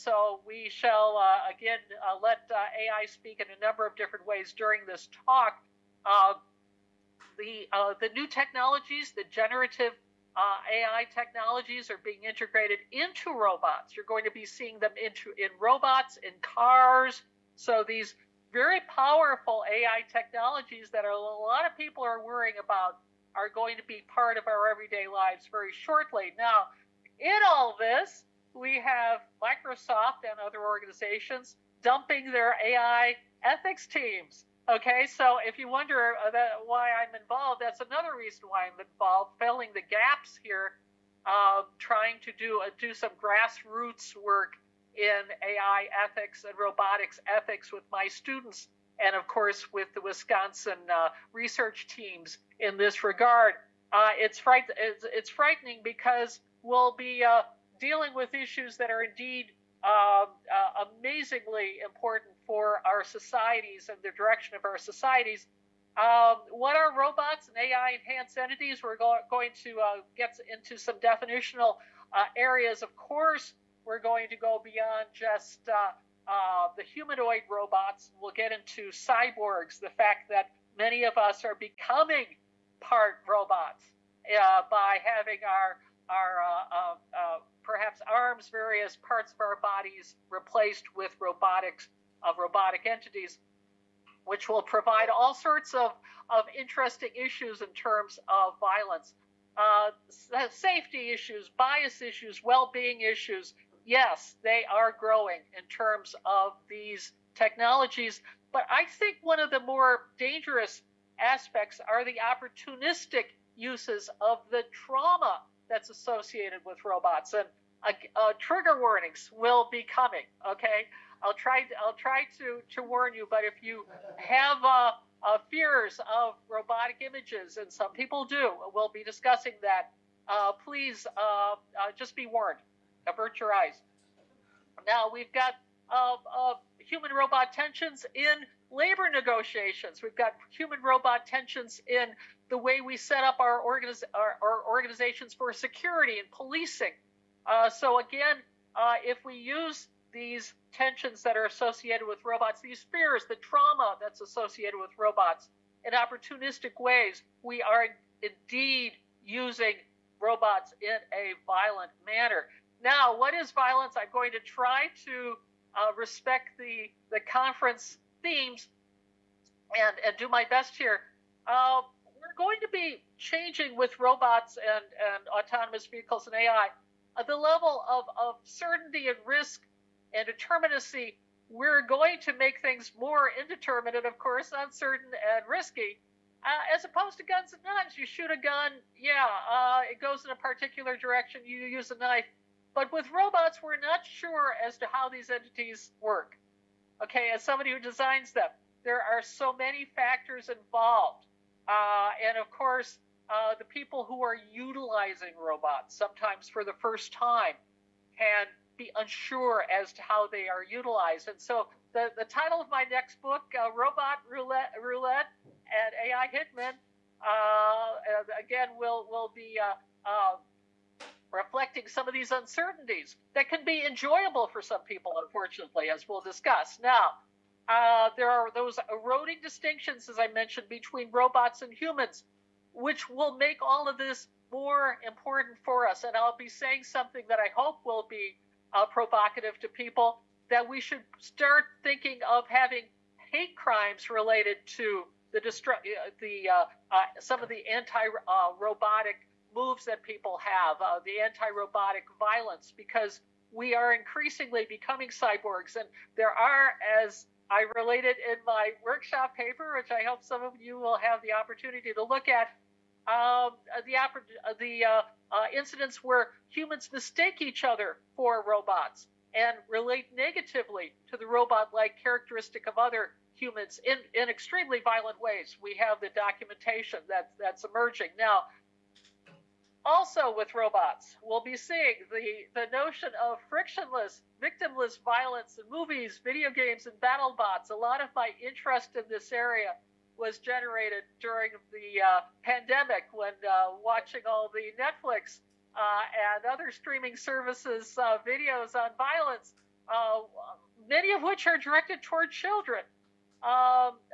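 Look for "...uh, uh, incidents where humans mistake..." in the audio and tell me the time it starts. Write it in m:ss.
4:24.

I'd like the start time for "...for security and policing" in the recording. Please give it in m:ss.
2:25.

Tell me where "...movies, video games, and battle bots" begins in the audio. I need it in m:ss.
4:45.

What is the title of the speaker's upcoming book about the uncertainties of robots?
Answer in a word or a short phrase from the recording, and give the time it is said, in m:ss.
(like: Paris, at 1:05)
Robot Roulette, at 3:33.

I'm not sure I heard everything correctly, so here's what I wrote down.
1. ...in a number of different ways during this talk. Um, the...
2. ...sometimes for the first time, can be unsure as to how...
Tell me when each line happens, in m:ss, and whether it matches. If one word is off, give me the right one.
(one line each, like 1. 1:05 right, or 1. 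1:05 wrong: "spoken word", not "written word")
1. 0:03 right
2. 3:25 right.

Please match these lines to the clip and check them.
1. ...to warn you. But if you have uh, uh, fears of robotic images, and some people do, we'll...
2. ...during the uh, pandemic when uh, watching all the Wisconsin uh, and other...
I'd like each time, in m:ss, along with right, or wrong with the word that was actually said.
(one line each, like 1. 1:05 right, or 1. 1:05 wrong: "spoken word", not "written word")
1. 2:02 right
2. 4:51 wrong: "Netflix", not "Wisconsin".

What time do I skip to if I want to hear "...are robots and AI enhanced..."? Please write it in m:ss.
1:06.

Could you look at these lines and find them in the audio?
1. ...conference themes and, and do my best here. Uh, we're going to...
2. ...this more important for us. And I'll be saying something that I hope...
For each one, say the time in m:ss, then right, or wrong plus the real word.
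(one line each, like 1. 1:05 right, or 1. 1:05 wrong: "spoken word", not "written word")
1. 2:47 right
2. 3:53 right.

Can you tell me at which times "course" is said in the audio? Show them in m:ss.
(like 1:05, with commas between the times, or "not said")
0:49, 1:12, 3:04, 3:22.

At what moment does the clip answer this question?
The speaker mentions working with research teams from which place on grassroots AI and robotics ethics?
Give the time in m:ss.
0:50.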